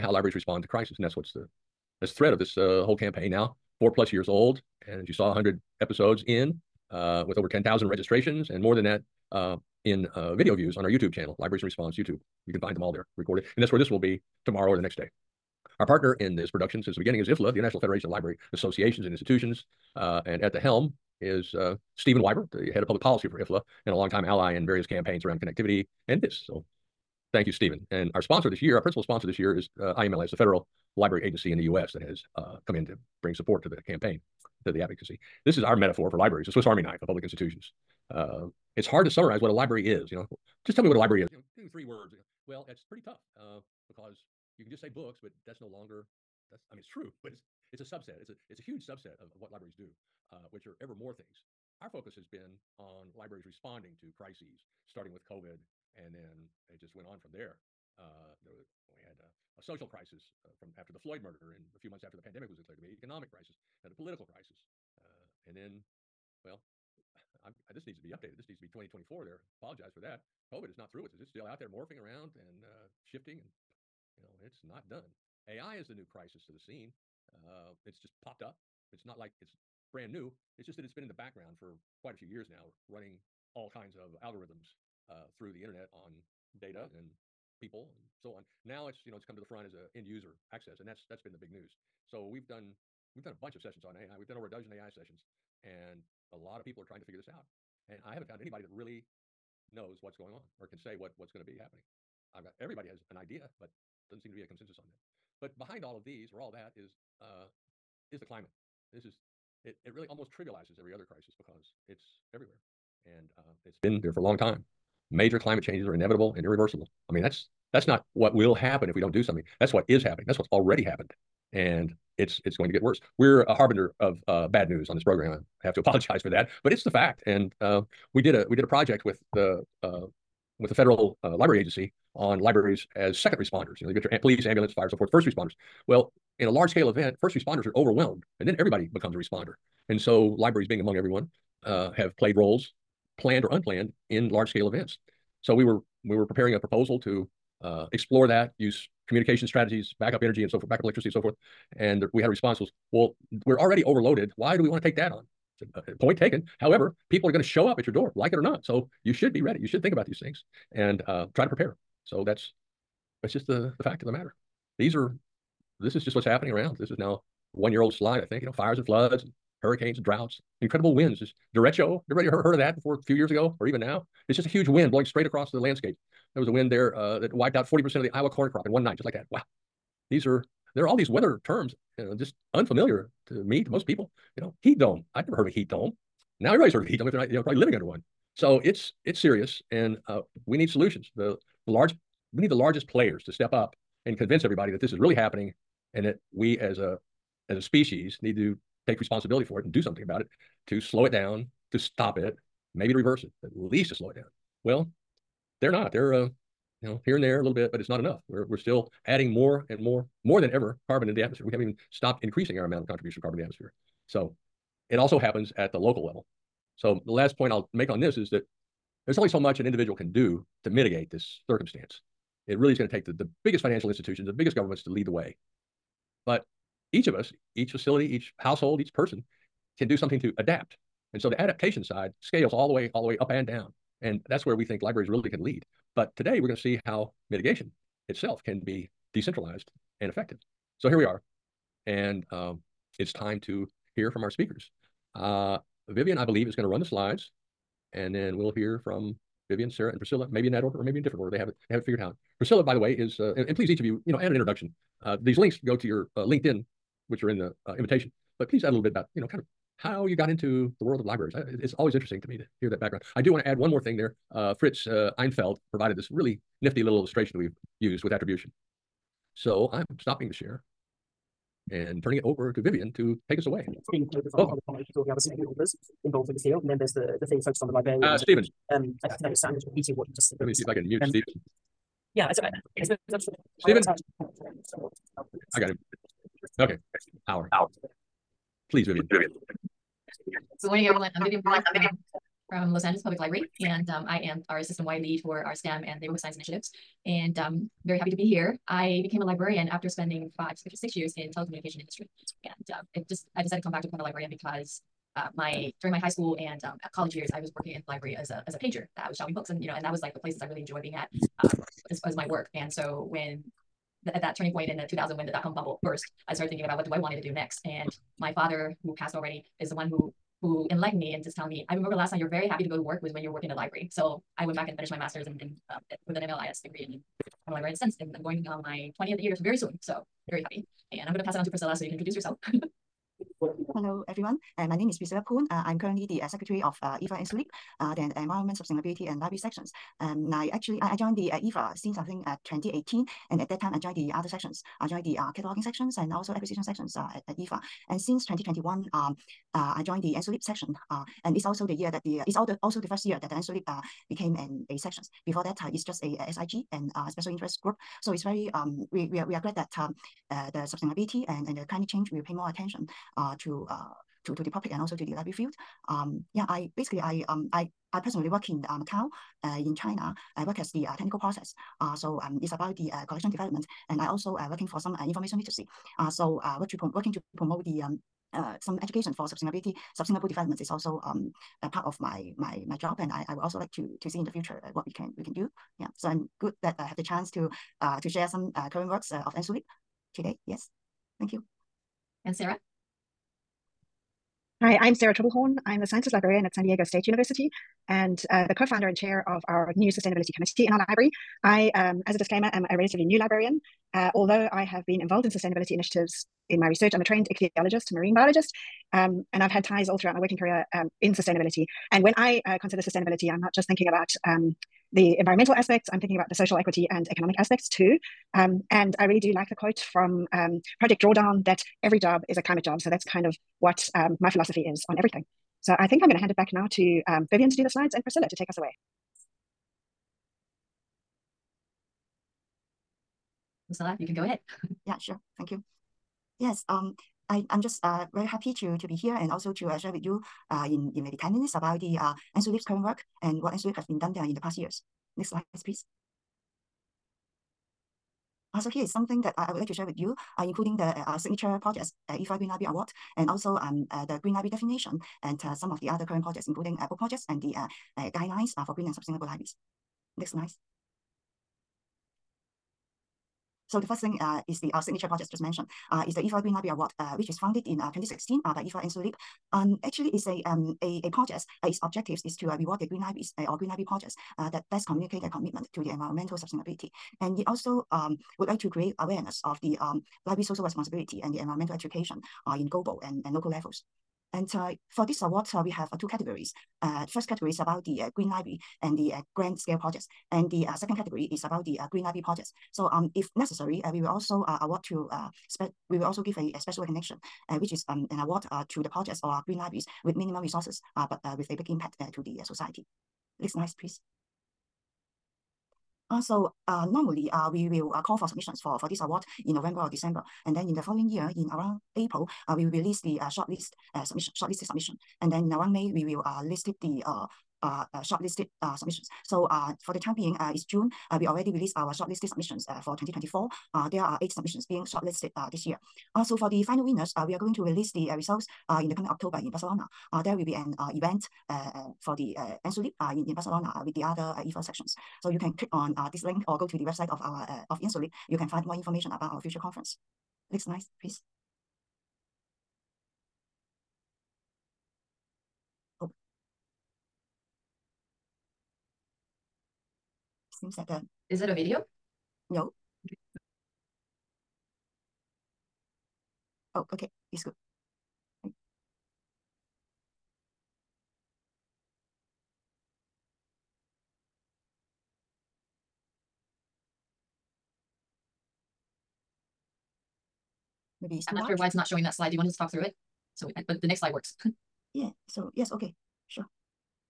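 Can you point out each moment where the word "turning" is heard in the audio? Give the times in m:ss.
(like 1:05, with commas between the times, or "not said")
4:32, 5:14.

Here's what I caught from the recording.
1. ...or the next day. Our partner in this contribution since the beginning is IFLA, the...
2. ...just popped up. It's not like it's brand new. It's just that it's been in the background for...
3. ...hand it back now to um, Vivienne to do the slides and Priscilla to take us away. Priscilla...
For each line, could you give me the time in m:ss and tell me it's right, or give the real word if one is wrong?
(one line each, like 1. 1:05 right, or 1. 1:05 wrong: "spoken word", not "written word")
1. 0:14 wrong: "production", not "contribution"
2. 1:17 right
3. 7:06 right.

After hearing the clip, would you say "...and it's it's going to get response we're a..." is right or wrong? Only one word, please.
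wrong.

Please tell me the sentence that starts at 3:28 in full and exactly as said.
We're we're still adding more and more, more than ever, carbon into the atmosphere.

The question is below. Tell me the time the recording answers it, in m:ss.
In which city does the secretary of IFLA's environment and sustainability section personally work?
6:08.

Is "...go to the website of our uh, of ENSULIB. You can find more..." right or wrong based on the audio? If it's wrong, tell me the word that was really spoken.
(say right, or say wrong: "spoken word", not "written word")
right.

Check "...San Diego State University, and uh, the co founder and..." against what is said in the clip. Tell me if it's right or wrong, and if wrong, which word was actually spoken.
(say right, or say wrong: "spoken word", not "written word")
right.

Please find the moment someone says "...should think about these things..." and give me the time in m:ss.
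2:39.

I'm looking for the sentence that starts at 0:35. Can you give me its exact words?
This is our metaphor for libraries, the Swiss Army knife of public institutions.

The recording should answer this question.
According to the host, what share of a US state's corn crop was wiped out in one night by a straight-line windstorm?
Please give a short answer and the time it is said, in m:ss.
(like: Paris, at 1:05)
40%, at 2:57.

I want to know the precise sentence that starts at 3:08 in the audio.
So it's it's serious, and uh, we need solutions.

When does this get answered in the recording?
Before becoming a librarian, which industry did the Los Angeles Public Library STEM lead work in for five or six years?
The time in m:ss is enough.
5:01.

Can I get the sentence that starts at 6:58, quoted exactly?
Um, and I really do like the quote from um, Project Drawdown that every job is a climate job.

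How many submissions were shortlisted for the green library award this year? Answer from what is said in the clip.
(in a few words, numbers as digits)
8.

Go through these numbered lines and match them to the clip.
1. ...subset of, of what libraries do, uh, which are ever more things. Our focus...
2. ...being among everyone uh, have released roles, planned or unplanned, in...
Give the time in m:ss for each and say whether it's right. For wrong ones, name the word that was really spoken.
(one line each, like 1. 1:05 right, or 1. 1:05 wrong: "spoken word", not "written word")
1. 0:48 right
2. 2:20 wrong: "played", not "released".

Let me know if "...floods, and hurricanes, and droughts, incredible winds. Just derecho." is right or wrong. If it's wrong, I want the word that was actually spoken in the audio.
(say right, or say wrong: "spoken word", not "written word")
right.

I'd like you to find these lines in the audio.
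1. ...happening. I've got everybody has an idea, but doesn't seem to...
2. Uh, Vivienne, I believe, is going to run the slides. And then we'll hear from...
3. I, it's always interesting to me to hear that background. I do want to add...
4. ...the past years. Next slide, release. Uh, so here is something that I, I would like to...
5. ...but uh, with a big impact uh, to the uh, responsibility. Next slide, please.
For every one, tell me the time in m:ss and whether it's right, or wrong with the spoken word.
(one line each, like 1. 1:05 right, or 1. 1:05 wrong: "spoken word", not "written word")
1. 1:41 right
2. 4:05 right
3. 4:21 right
4. 7:24 wrong: "please", not "release"
5. 8:21 wrong: "society", not "responsibility".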